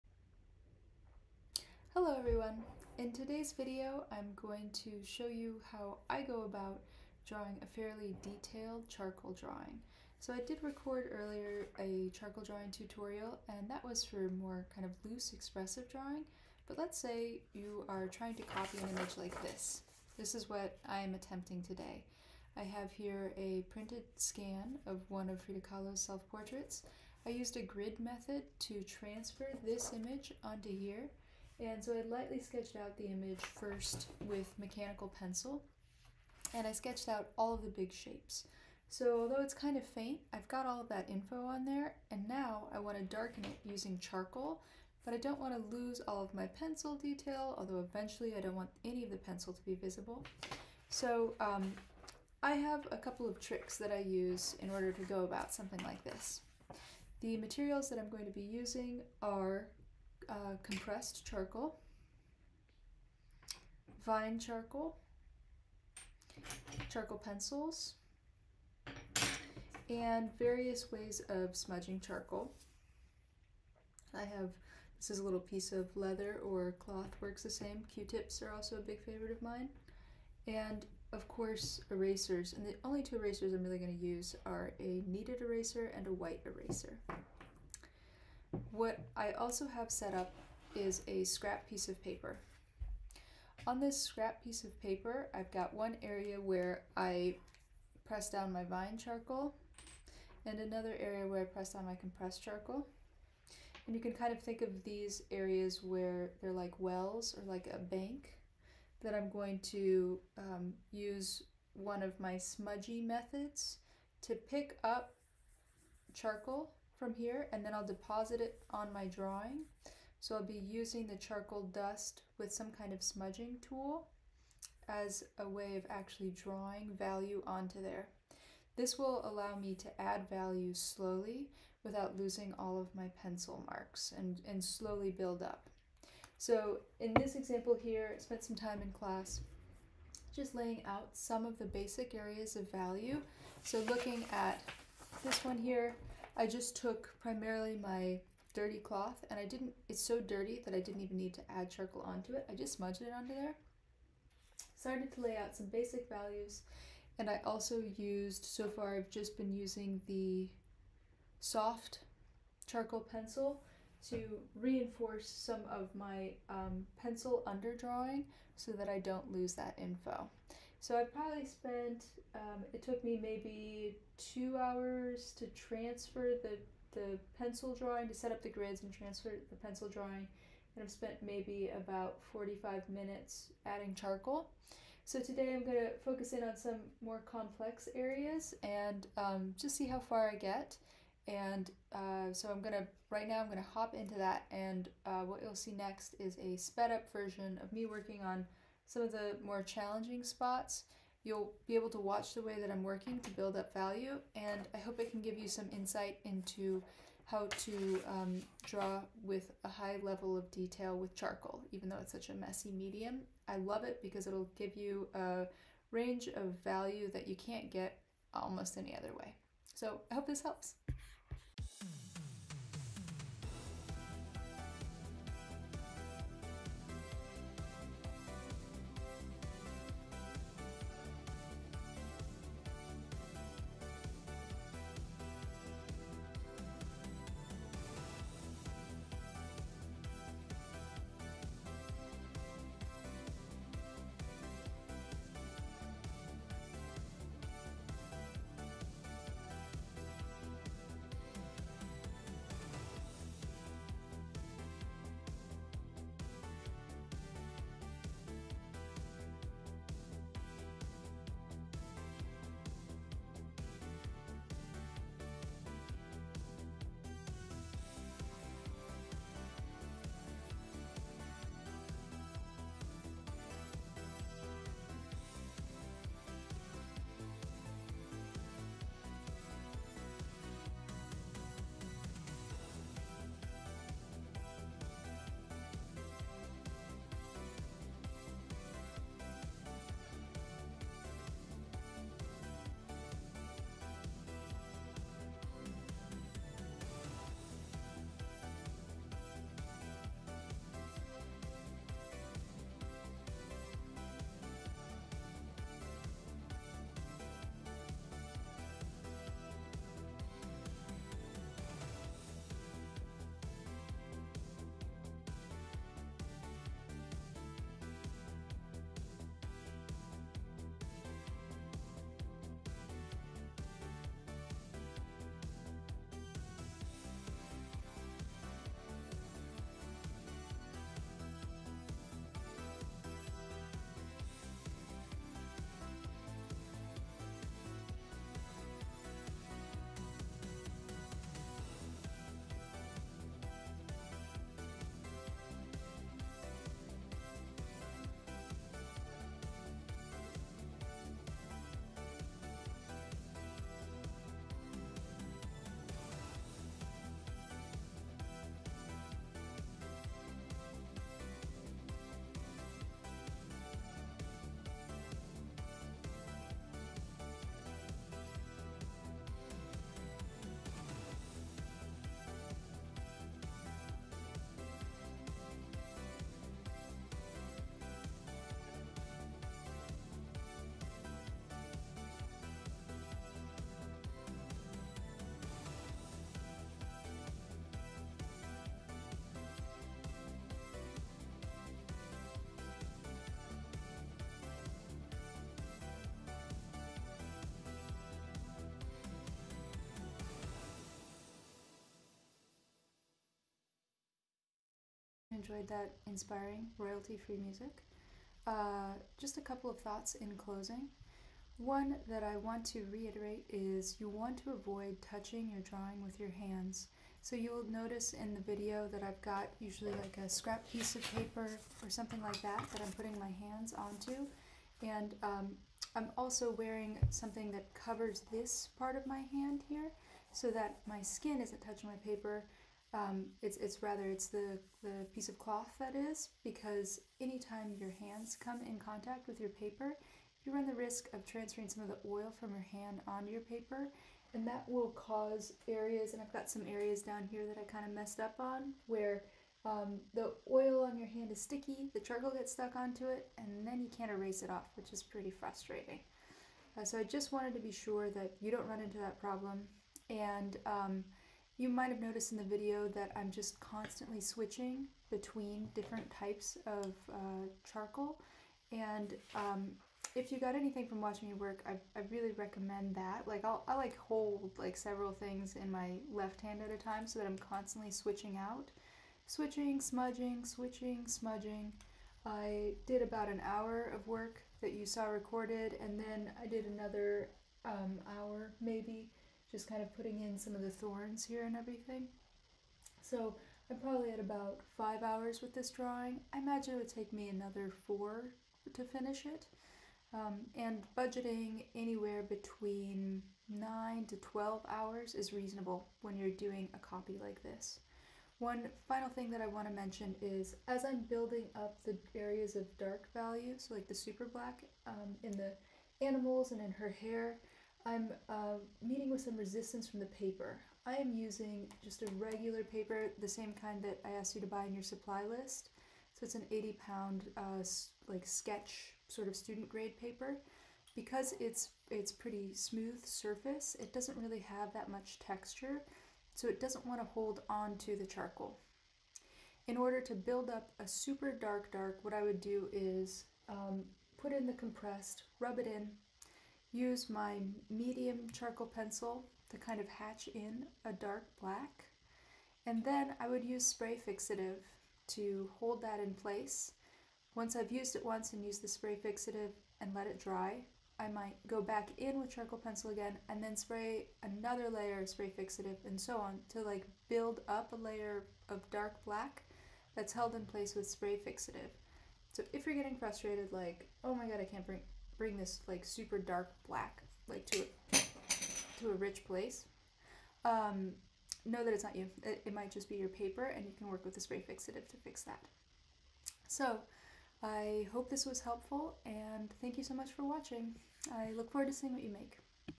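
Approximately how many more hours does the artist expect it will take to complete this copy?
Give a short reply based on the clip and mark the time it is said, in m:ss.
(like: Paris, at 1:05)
4, at 8:17.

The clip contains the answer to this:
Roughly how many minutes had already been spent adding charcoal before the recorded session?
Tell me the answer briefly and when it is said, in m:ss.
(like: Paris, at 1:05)
45, at 3:02.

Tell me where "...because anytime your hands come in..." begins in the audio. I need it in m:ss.
7:16.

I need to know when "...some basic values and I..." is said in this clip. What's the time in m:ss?
2:35.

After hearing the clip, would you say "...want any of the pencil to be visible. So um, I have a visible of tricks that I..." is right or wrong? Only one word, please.
wrong.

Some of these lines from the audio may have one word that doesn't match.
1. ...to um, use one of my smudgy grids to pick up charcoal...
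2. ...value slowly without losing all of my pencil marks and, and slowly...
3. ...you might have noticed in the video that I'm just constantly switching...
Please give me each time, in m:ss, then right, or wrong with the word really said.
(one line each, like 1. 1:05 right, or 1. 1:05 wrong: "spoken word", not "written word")
1. 1:49 wrong: "methods", not "grids"
2. 2:10 right
3. 7:41 right.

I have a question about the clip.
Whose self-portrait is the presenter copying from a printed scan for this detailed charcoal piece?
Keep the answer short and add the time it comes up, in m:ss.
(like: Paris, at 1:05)
Frida Kahlo, at 0:25.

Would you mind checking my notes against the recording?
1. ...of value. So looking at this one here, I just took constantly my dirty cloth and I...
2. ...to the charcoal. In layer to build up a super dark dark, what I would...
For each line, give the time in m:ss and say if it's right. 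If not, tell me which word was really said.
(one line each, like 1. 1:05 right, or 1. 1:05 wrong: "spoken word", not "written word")
1. 2:22 wrong: "primarily", not "constantly"
2. 8:57 wrong: "order", not "layer".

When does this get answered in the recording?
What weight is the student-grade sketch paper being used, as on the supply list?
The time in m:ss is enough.
8:46.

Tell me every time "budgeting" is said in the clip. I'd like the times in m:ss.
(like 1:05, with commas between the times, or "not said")
8:20.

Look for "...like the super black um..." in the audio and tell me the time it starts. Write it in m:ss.
8:33.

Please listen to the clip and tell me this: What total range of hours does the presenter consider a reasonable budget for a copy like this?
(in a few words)
9 to 12 hours.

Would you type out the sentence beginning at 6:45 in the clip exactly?
enjoyed that inspiring royalty free music.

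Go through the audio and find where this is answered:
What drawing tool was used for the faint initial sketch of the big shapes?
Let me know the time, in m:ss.
0:34.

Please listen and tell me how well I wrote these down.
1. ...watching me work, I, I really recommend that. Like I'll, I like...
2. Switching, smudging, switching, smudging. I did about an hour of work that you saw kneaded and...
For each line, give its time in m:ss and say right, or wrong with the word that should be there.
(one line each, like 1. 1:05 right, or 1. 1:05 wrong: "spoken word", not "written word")
1. 7:51 right
2. 7:59 wrong: "recorded", not "kneaded".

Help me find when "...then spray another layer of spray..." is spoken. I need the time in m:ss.
9:23.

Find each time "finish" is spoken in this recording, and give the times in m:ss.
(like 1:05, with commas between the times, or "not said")
8:18.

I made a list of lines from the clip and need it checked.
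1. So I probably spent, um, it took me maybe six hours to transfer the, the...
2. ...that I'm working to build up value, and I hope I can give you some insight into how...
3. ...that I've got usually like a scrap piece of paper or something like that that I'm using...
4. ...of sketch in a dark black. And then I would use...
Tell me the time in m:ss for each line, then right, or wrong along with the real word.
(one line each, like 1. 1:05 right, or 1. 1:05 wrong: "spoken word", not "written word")
1. 2:50 wrong: "two", not "six"
2. 3:22 right
3. 6:58 wrong: "putting", not "using"
4. 9:09 wrong: "hatch", not "sketch".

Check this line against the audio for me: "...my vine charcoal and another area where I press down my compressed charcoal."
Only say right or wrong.
right.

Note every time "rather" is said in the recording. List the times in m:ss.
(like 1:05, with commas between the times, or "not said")
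7:13.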